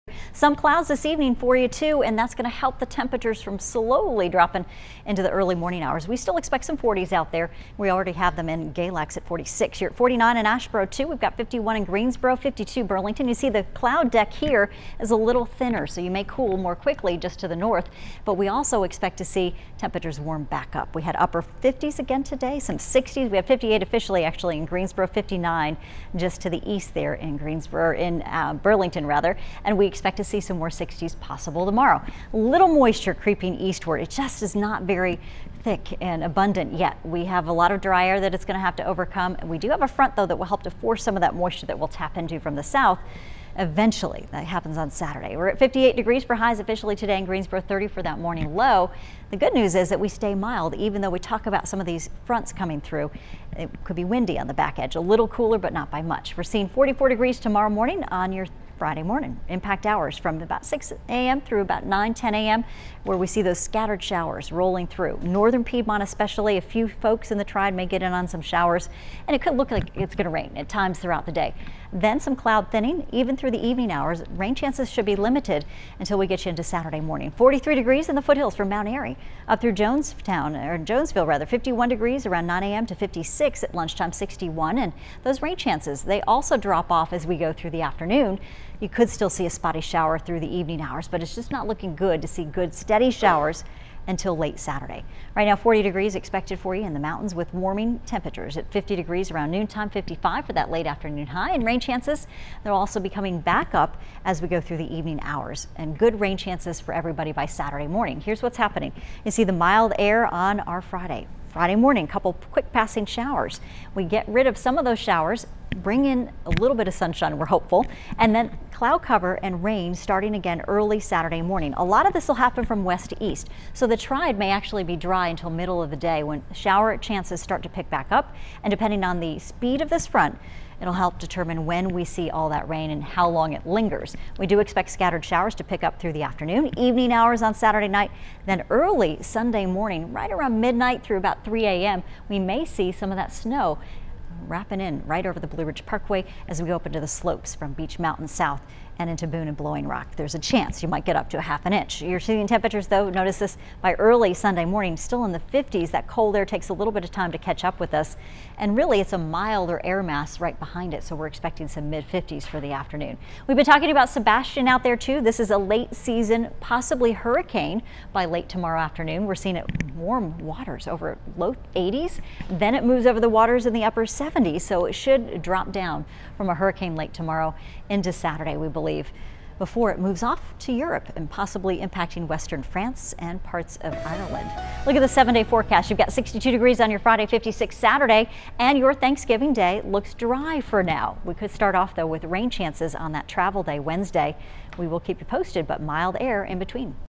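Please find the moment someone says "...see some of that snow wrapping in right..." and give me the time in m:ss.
2:22.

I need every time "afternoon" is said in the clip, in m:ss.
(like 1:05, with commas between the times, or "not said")
1:27, 1:40, 2:16, 2:42, 2:48.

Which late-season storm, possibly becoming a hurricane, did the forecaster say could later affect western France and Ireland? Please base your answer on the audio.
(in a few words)
Sebastian.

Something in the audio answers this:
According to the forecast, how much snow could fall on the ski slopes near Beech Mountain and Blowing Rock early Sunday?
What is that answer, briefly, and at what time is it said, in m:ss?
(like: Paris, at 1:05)
half an inch, at 2:31.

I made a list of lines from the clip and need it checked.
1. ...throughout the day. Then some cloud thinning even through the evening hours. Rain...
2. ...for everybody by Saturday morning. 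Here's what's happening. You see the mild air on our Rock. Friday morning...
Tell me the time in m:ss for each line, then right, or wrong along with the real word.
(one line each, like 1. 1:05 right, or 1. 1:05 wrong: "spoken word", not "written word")
1. 1:10 right
2. 1:46 wrong: "Friday", not "Rock".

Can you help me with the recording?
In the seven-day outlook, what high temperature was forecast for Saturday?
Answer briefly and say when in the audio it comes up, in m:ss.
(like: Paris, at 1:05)
56, at 3:07.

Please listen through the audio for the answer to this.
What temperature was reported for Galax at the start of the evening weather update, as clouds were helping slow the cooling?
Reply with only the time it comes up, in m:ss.
0:08.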